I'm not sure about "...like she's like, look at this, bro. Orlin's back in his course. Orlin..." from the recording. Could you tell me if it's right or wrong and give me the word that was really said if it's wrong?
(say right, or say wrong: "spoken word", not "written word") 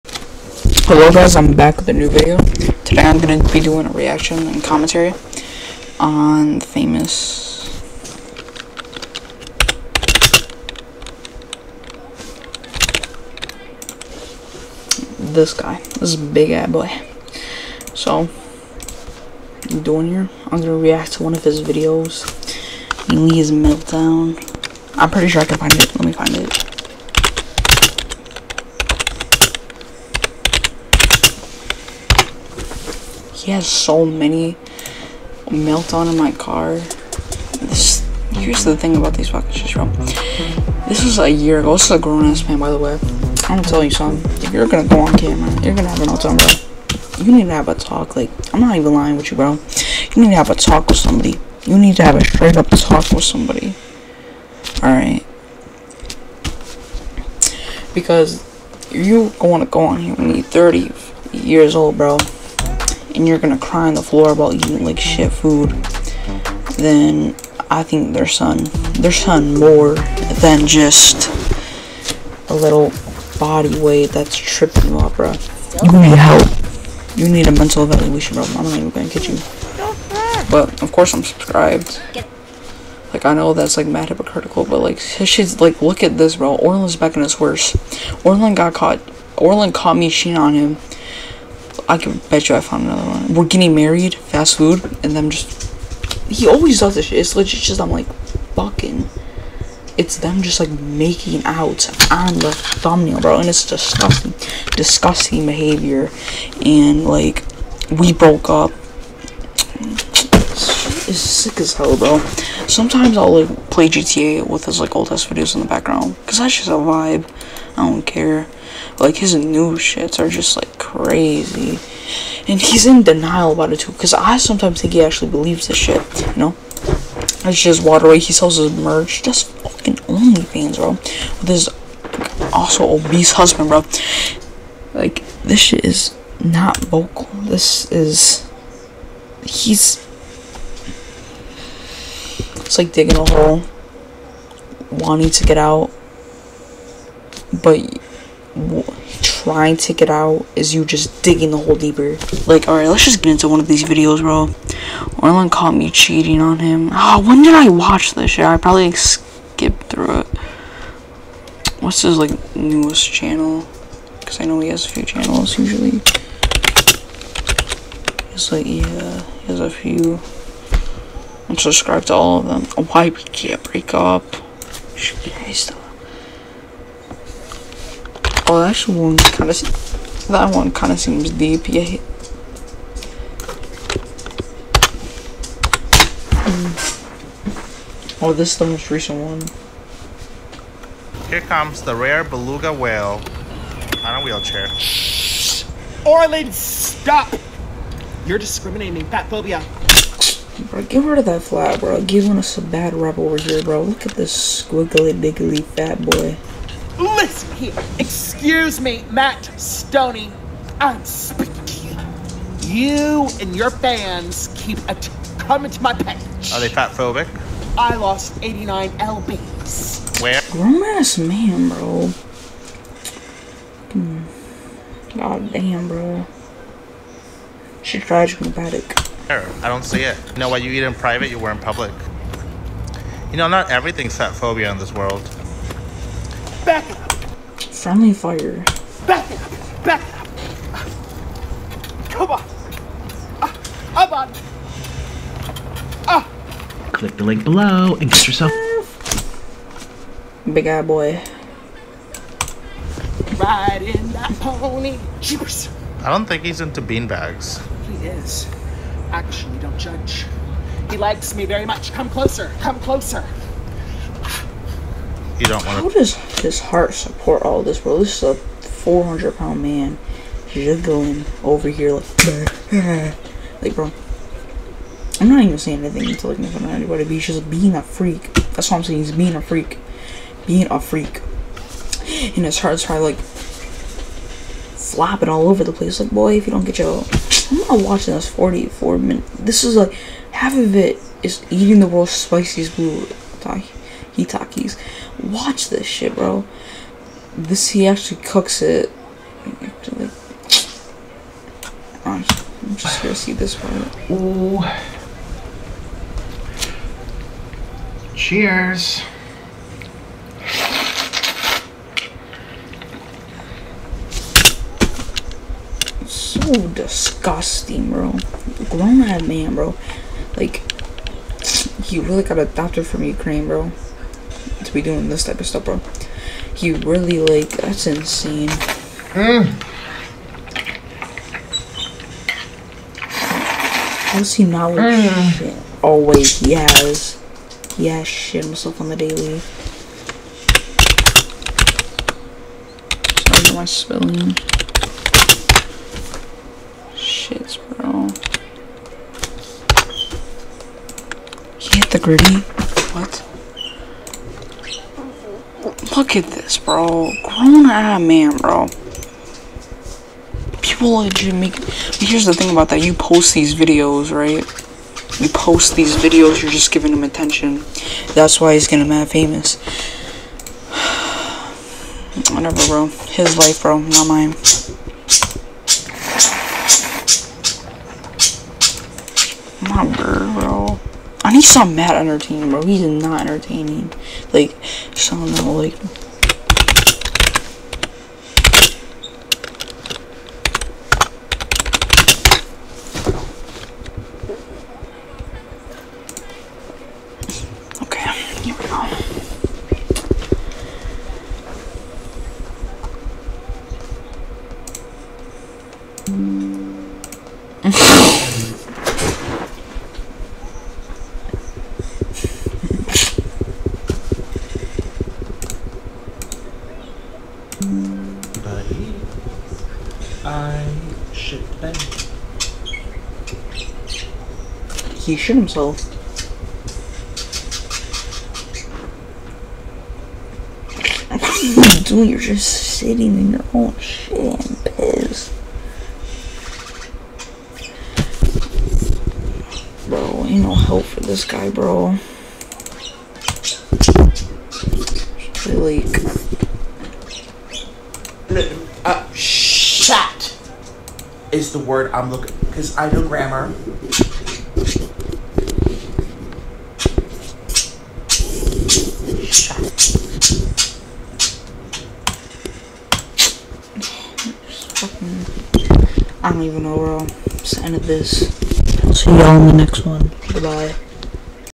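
wrong: "worse", not "course".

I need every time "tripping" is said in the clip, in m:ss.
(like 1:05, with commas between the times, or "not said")
1:14.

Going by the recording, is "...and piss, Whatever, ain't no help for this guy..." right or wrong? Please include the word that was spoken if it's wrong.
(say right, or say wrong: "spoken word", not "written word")
wrong: "Bro", not "Whatever".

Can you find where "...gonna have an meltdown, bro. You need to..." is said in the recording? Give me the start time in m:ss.
0:45.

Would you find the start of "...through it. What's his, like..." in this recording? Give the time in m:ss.
2:39.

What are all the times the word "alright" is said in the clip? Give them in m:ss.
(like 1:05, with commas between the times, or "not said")
0:54, 2:32.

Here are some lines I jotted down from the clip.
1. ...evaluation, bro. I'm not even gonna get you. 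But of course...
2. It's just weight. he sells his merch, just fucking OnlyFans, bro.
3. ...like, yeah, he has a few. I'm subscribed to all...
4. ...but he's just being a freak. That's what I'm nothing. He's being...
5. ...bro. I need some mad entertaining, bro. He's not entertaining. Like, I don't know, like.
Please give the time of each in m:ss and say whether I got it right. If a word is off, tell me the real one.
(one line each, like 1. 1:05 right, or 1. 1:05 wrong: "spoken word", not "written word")
1. 1:17 right
2. 2:07 right
3. 2:48 right
4. 4:37 wrong: "saying", not "nothing"
5. 6:19 right.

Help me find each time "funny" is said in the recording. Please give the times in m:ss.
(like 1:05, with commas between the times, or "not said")
not said.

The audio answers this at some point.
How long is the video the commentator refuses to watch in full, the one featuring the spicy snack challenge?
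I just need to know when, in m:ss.
4:48.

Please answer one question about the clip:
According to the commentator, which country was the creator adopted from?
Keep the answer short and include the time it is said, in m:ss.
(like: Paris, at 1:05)
Ukraine, at 5:23.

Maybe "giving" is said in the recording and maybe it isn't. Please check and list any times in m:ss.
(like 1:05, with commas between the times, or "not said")
3:22, 6:06.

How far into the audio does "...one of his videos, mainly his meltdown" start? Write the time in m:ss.
0:21.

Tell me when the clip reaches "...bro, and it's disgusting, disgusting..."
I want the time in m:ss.
1:43.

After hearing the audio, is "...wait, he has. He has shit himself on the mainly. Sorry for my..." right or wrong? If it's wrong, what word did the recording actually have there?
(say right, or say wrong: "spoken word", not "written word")
wrong: "daily", not "mainly".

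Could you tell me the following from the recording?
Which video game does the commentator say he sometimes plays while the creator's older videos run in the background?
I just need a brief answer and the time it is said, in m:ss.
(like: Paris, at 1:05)
GTA, at 1:53.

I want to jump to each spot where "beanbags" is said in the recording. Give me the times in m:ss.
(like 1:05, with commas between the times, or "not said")
4:16.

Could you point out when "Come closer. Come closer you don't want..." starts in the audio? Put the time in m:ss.
4:21.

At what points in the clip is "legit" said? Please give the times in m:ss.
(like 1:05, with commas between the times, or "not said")
1:37, 6:00.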